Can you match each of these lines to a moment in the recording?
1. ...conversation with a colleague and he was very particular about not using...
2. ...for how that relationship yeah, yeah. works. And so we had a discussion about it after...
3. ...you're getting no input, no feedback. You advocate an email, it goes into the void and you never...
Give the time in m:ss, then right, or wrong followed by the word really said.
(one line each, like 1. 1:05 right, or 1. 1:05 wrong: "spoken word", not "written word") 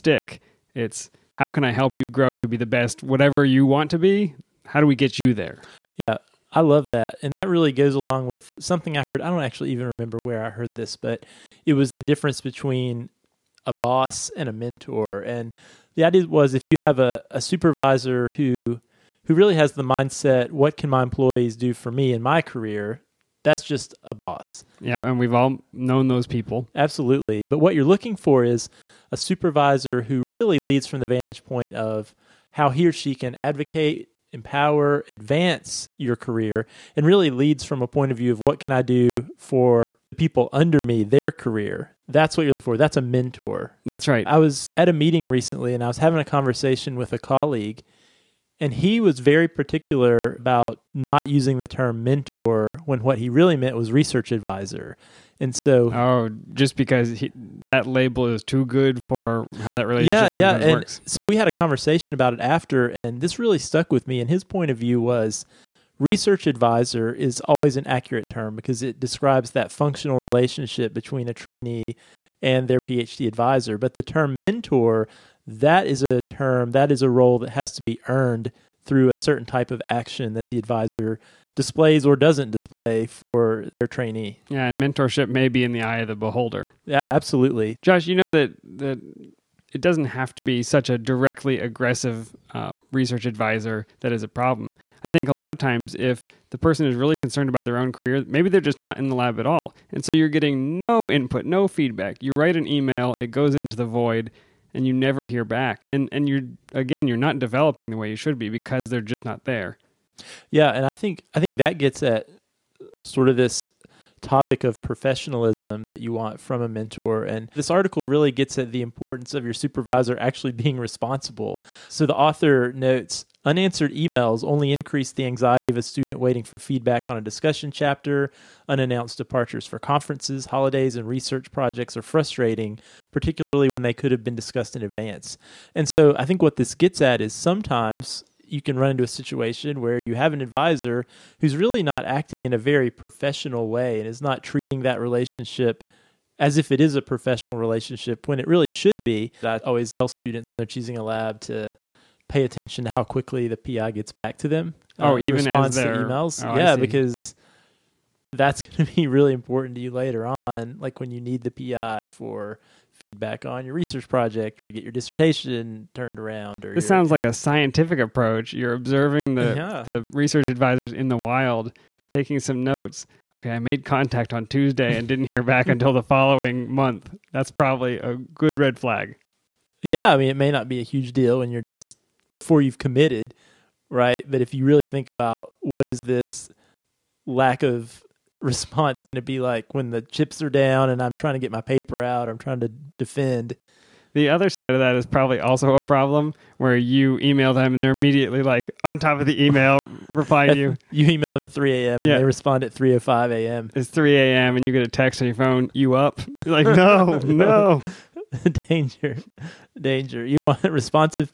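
1. 0:46 right
2. 0:59 wrong: "conversation", not "discussion"
3. 1:40 wrong: "write", not "advocate".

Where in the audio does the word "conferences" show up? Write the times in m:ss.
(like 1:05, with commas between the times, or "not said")
2:09.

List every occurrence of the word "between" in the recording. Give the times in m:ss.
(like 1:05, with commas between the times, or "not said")
0:12, 1:10.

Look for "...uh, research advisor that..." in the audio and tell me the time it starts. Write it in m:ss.
1:32.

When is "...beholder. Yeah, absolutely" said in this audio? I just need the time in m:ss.
1:26.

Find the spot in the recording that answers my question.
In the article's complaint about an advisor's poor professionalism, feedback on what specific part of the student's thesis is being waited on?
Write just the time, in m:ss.
2:07.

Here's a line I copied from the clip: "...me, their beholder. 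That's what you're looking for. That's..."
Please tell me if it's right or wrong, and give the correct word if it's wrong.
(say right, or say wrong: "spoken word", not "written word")
wrong: "career", not "beholder".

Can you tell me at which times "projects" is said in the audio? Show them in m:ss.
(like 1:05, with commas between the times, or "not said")
2:11, 2:44.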